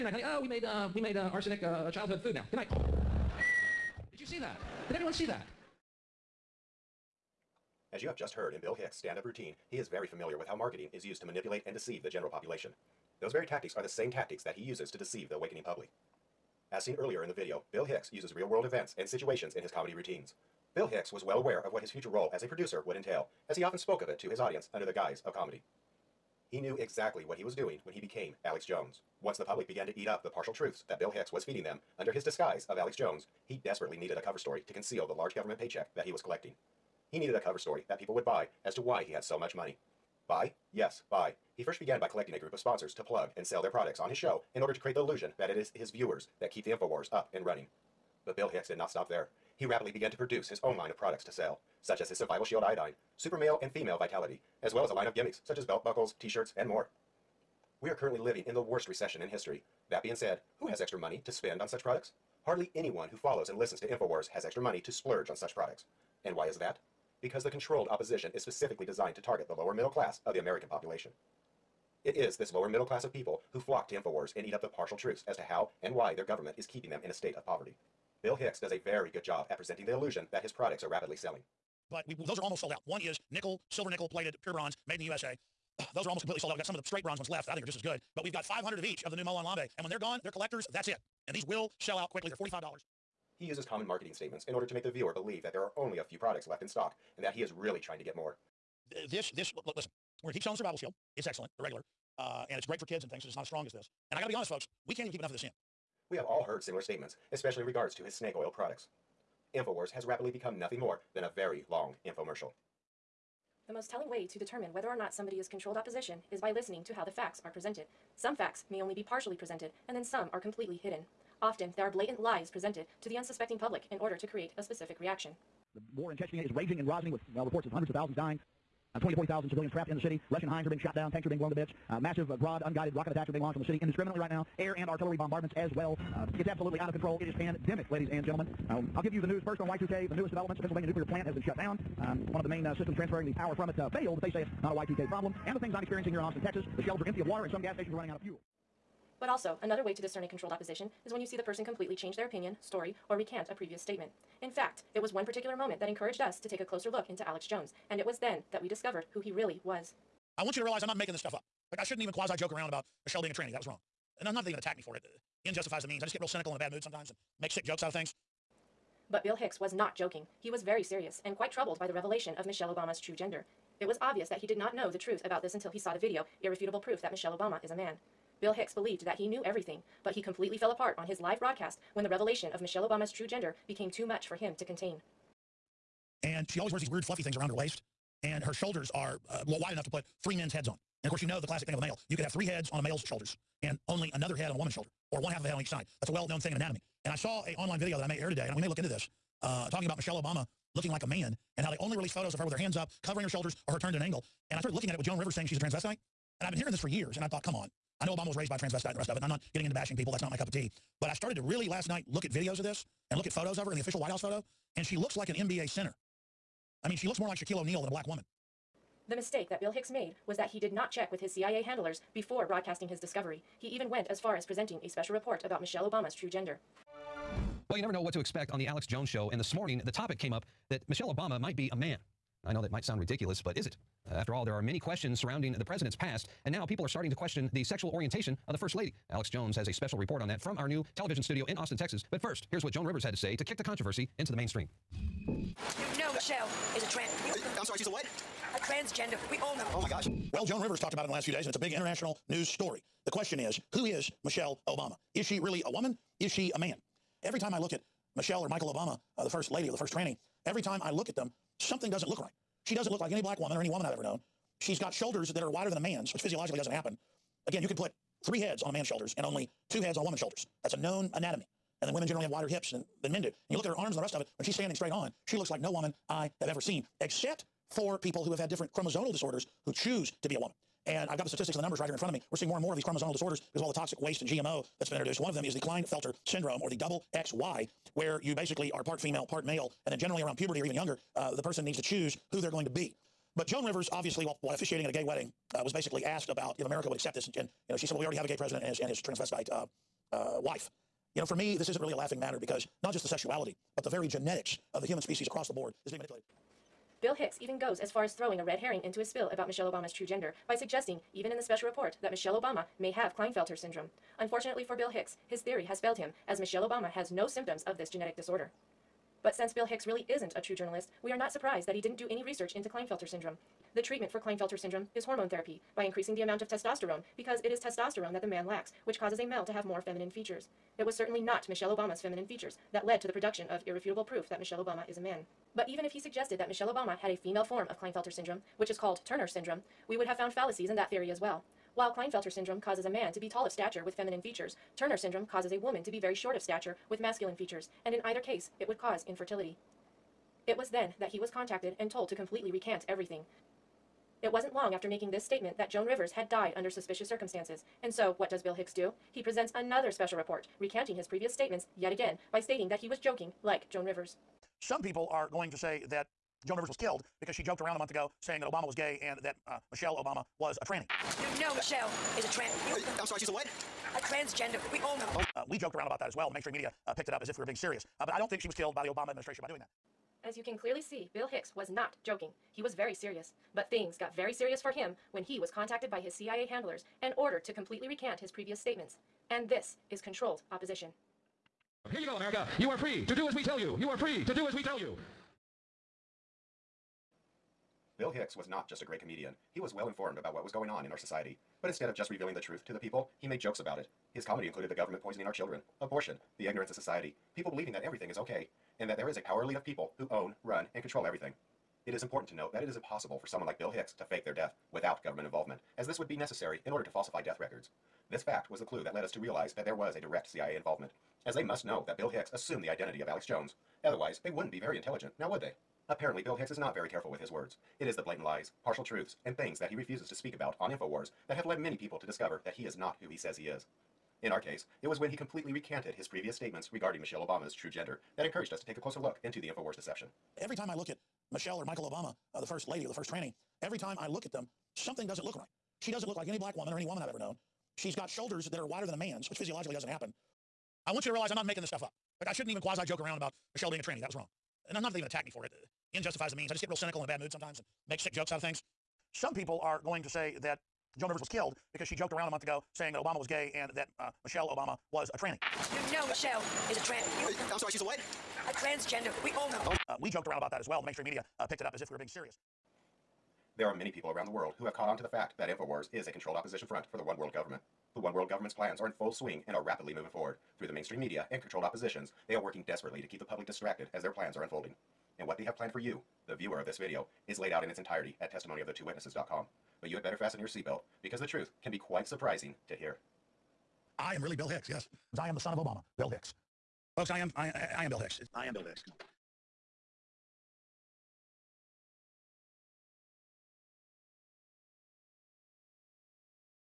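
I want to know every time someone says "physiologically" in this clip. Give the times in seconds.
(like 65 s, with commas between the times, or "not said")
266 s, 449 s.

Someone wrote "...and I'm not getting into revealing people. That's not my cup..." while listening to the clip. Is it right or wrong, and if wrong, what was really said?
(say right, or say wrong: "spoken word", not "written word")
wrong: "bashing", not "revealing".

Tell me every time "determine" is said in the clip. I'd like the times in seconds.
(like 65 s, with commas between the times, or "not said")
114 s.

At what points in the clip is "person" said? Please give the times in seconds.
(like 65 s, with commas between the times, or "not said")
151 s, 291 s.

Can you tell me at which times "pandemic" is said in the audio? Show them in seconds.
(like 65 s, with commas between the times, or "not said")
137 s.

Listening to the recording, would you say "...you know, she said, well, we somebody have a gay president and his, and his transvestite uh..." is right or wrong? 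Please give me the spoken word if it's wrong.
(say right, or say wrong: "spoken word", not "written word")
wrong: "already", not "somebody".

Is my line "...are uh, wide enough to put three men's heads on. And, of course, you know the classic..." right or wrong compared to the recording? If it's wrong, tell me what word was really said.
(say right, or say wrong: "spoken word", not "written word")
right.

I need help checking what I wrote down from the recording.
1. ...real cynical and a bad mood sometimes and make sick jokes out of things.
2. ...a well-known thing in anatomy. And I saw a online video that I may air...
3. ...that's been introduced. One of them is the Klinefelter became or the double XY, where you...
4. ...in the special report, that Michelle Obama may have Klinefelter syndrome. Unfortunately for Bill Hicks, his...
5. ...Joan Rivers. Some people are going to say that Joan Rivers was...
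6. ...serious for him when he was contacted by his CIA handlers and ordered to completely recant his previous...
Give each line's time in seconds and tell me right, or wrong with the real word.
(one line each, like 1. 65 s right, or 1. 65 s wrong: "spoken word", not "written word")
1. 166 s right
2. 196 s right
3. 284 s wrong: "syndrome", not "became"
4. 311 s right
5. 363 s right
6. 384 s right.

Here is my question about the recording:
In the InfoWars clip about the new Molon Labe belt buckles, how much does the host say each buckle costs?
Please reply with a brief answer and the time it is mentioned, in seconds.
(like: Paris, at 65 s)
$45, at 92 s.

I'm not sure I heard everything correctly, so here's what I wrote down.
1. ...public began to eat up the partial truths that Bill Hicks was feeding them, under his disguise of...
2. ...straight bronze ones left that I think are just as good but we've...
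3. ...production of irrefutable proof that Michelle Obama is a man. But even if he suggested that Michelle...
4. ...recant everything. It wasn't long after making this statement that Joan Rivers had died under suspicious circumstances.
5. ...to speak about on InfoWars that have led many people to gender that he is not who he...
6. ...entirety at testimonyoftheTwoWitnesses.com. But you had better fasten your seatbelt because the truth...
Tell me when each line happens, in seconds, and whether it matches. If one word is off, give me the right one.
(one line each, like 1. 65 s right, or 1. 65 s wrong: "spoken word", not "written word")
1. 29 s right
2. 86 s right
3. 333 s right
4. 352 s right
5. 430 s wrong: "discover", not "gender"
6. 487 s right.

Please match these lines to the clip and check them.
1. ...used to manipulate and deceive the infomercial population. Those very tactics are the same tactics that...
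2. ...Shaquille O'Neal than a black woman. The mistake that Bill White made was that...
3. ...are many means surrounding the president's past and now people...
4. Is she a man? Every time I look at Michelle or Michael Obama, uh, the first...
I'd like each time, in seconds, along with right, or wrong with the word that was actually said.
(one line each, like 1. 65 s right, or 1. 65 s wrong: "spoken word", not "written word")
1. 11 s wrong: "general", not "infomercial"
2. 217 s wrong: "Hicks", not "White"
3. 234 s wrong: "questions", not "means"
4. 256 s right.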